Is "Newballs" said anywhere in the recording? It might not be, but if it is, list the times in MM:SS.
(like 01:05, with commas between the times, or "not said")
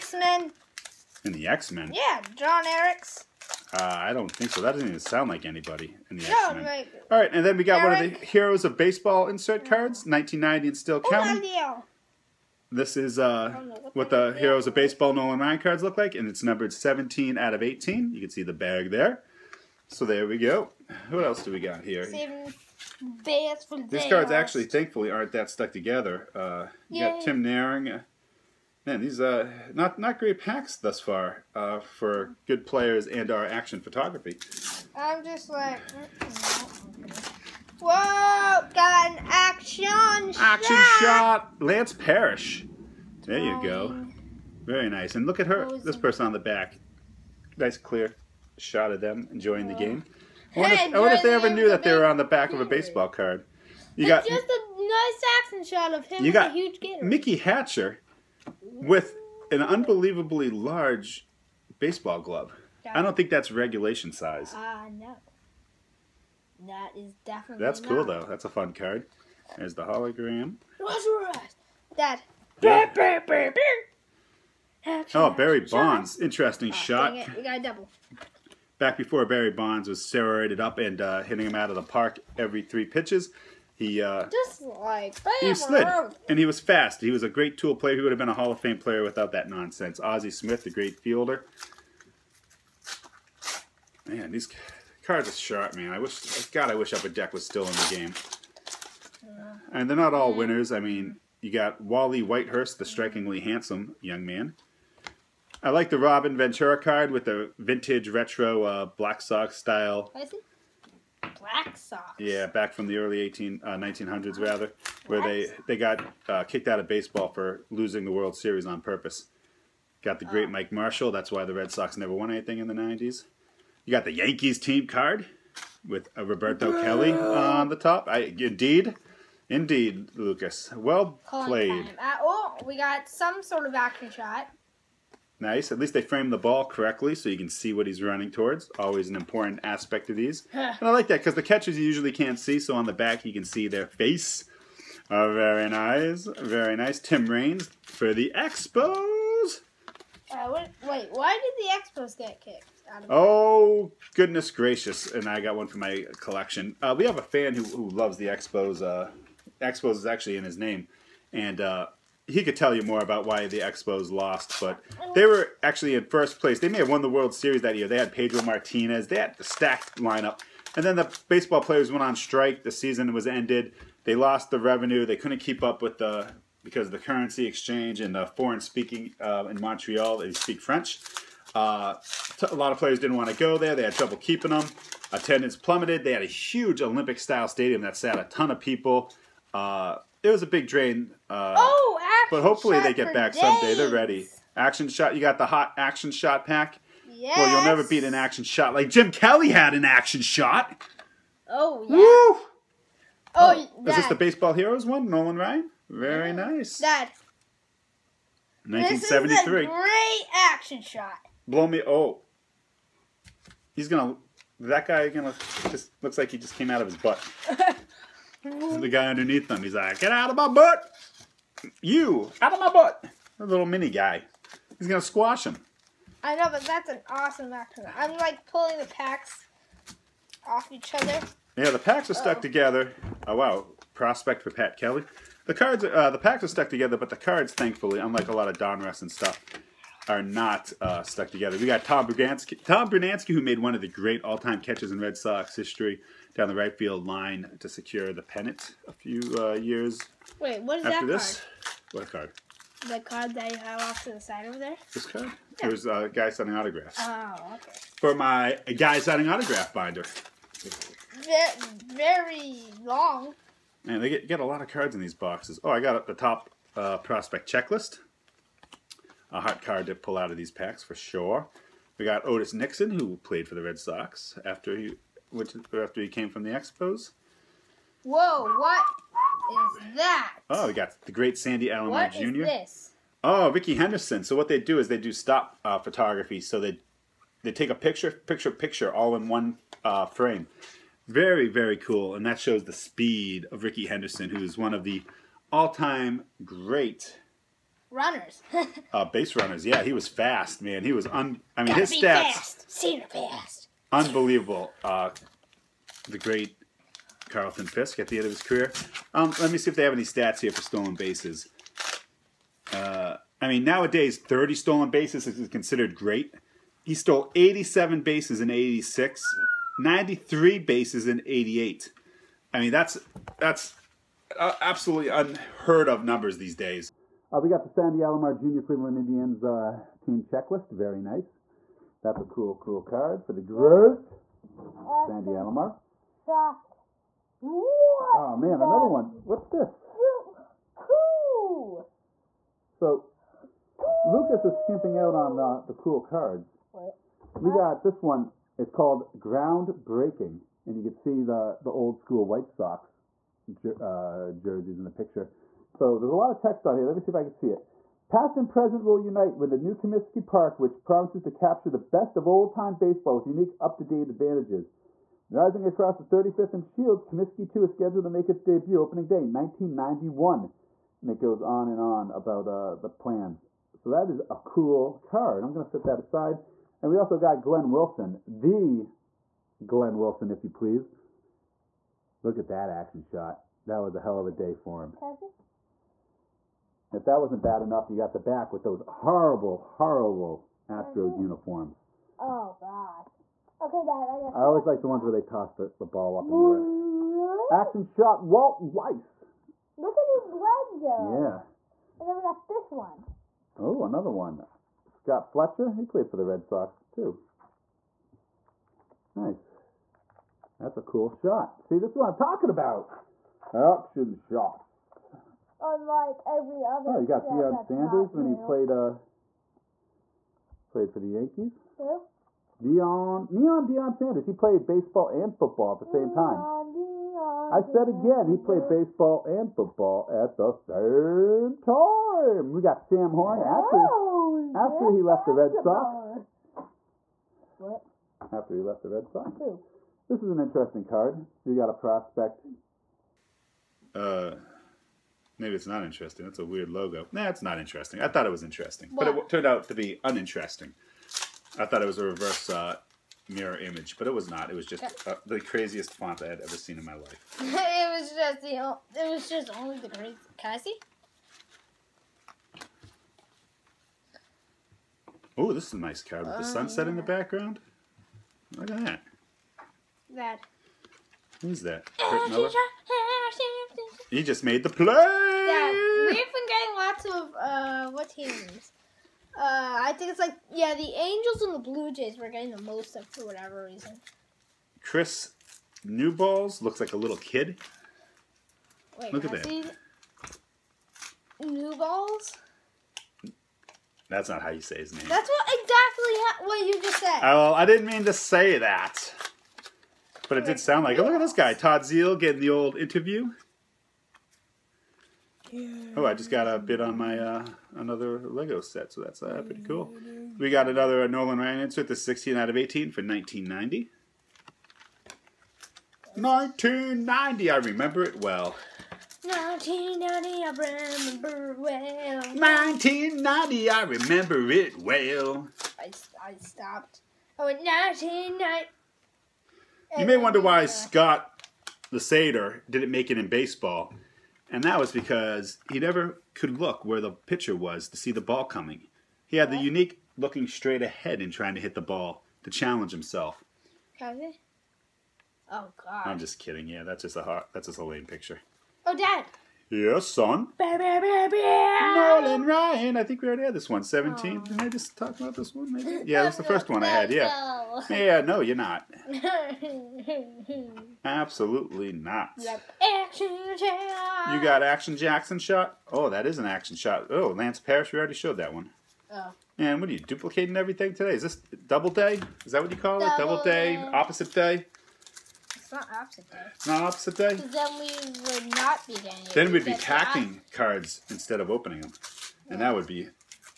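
08:05, 08:11.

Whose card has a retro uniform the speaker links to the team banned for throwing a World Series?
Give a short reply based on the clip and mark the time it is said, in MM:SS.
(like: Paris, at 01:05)
Robin Ventura, at 01:45.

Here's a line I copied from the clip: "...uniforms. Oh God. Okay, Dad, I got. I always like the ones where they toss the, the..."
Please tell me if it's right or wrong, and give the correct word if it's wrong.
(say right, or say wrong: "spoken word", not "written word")
right.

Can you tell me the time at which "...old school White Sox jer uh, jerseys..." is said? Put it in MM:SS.
05:51.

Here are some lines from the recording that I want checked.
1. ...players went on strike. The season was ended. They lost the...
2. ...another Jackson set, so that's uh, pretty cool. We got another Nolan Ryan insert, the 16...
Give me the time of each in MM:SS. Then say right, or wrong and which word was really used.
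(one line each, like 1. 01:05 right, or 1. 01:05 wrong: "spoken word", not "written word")
1. 02:51 right
2. 08:27 wrong: "Lego", not "Jackson".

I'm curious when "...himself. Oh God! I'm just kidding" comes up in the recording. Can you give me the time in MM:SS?
09:02.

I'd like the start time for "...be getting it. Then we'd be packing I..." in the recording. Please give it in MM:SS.
09:38.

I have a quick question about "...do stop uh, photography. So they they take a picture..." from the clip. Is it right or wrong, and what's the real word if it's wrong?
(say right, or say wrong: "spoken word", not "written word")
right.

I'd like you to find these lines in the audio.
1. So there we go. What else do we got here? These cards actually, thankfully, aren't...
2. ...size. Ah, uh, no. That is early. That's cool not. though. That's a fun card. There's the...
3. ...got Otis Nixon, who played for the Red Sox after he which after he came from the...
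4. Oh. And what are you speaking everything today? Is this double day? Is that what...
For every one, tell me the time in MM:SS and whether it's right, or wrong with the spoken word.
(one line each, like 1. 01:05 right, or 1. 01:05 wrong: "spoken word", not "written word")
1. 00:19 right
2. 01:04 wrong: "definitely", not "early"
3. 04:32 right
4. 09:29 wrong: "duplicating", not "speaking".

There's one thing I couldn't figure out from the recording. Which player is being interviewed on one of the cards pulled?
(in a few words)
Todd Zeile.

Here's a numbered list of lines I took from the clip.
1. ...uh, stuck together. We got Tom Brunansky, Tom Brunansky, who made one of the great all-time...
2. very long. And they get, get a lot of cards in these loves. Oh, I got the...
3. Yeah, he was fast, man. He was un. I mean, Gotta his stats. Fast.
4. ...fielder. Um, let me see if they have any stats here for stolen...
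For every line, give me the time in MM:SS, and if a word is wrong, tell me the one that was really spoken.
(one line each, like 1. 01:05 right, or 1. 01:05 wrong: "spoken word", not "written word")
1. 04:00 right
2. 04:21 wrong: "boxes", not "loves"
3. 04:59 right
4. 05:08 wrong: "career", not "fielder".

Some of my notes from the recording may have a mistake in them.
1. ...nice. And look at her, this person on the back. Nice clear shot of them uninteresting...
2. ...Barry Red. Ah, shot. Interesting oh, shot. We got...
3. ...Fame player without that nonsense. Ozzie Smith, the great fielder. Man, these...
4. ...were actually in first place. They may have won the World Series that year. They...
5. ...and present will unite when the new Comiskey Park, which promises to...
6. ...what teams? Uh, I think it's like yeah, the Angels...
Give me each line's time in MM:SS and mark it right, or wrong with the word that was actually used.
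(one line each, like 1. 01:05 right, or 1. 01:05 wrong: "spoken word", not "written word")
1. 00:44 wrong: "enjoying", not "uninteresting"
2. 01:15 wrong: "Bonds", not "Red"
3. 01:28 right
4. 02:45 right
5. 05:58 right
6. 07:57 right.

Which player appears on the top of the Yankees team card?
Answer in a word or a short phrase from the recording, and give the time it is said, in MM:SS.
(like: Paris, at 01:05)
Roberto Kelly, at 02:06.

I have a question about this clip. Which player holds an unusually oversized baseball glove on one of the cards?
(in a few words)
Mickey Hatcher.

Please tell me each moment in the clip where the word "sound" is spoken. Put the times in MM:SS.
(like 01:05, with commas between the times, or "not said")
00:04, 08:20.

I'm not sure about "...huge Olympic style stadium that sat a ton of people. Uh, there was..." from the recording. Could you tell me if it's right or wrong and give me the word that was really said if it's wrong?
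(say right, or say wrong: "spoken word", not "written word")
right.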